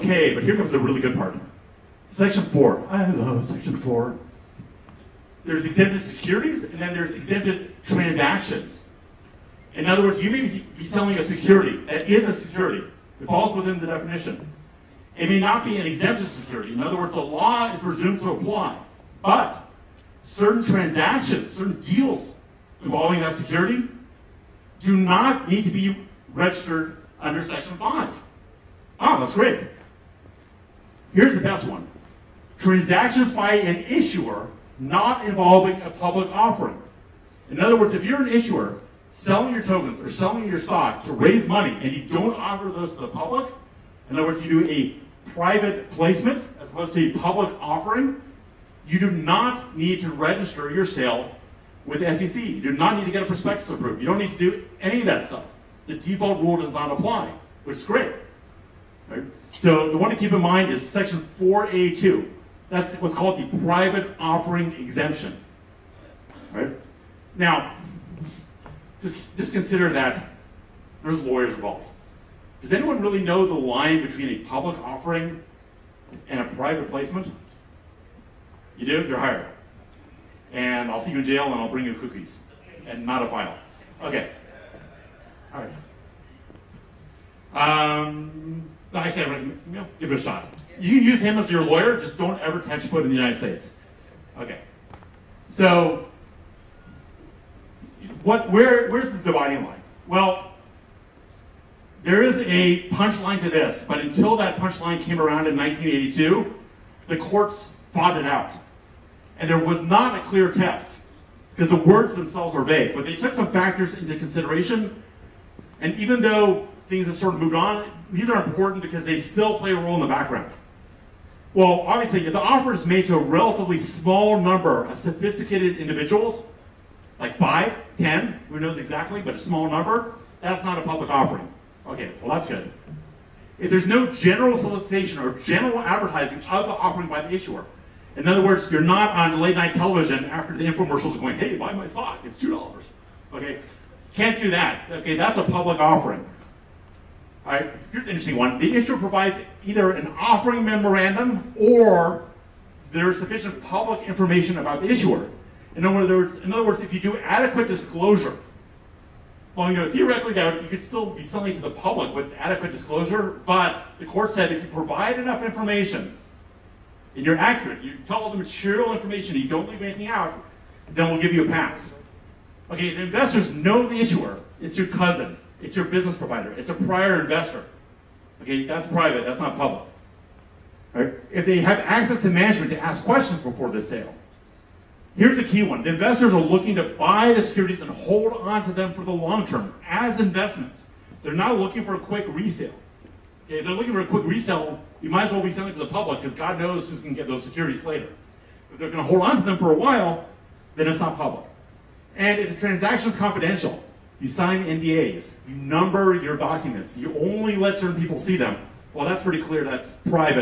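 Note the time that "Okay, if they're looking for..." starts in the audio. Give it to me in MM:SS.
03:13.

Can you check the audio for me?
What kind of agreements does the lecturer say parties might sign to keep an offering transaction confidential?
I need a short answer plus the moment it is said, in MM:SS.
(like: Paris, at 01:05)
NDAs, at 03:24.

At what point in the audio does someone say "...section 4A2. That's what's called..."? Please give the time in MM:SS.
01:00.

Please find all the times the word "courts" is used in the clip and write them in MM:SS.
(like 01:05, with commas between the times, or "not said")
01:47, 02:44.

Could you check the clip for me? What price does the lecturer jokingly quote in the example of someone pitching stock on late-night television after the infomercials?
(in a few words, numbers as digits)
$2.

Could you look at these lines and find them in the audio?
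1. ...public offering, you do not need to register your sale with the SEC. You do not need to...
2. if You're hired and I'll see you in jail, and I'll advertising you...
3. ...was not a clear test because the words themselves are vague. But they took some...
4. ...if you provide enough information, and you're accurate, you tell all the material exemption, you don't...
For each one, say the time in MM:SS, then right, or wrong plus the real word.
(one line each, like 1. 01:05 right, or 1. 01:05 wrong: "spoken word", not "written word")
1. 00:47 right
2. 01:18 wrong: "bring", not "advertising"
3. 01:49 right
4. 02:44 wrong: "information", not "exemption".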